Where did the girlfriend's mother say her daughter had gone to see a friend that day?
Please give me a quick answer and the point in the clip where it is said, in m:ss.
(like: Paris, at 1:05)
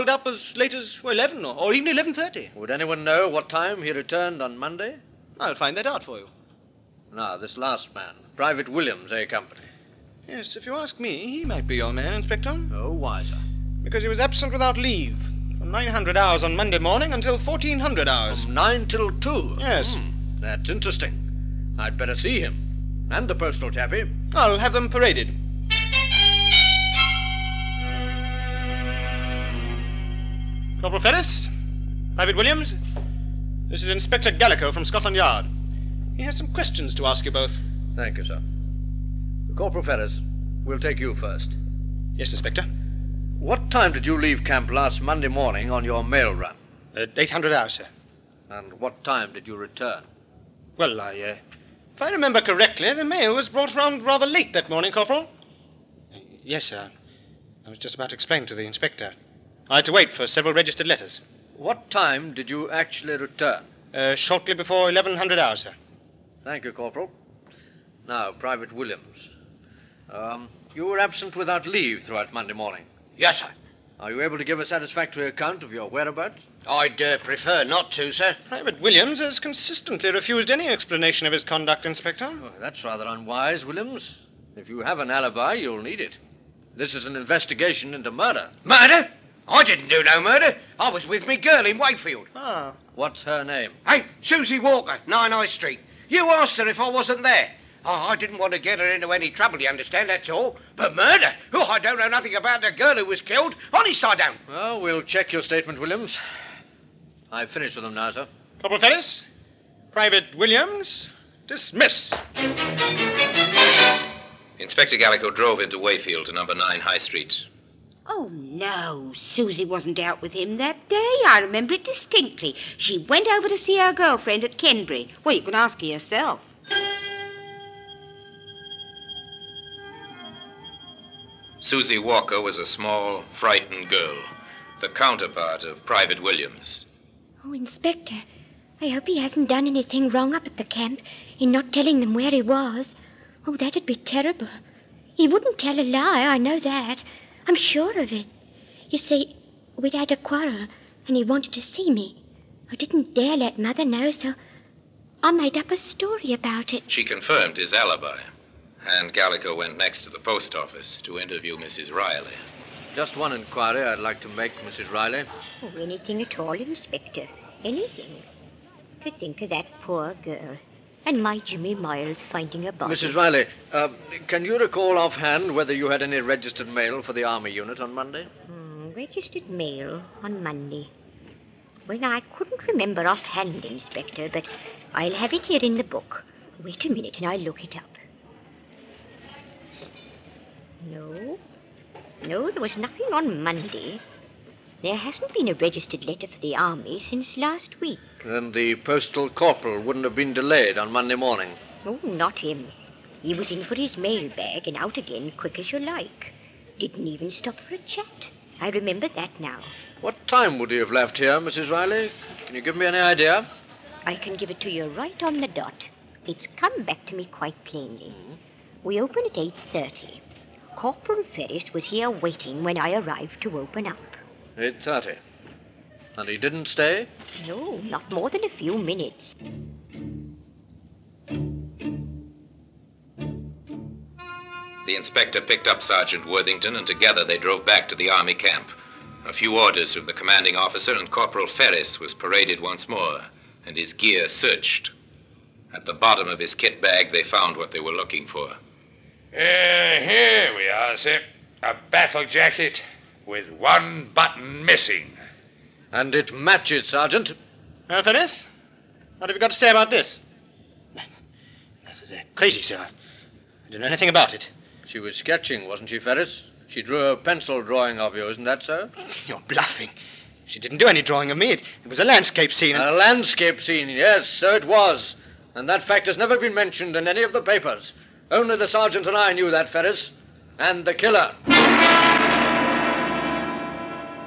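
Kenbury, at 2:04.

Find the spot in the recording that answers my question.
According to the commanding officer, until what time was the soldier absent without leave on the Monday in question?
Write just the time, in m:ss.
0:17.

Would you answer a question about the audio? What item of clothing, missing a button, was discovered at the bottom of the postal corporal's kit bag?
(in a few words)
Battle jacket.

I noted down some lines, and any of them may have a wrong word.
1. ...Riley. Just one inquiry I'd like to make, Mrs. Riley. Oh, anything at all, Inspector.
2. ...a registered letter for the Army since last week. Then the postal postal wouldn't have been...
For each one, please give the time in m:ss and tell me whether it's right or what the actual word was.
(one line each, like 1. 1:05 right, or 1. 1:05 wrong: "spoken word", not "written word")
1. 2:41 right
2. 3:15 wrong: "corporal", not "postal".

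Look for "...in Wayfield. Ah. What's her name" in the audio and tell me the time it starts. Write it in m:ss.
1:31.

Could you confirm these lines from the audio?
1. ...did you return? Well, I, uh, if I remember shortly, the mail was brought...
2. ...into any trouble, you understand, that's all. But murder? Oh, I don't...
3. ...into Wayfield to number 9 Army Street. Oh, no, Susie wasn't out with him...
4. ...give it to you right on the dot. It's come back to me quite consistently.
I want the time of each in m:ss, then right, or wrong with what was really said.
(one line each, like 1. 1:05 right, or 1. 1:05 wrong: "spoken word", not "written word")
1. 0:49 wrong: "correctly", not "shortly"
2. 1:38 right
3. 1:55 wrong: "High", not "Army"
4. 3:34 wrong: "plainly", not "consistently".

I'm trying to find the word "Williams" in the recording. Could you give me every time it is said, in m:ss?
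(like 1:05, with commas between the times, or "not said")
0:08, 0:32, 1:08, 1:18, 1:23, 1:45, 1:50, 2:16.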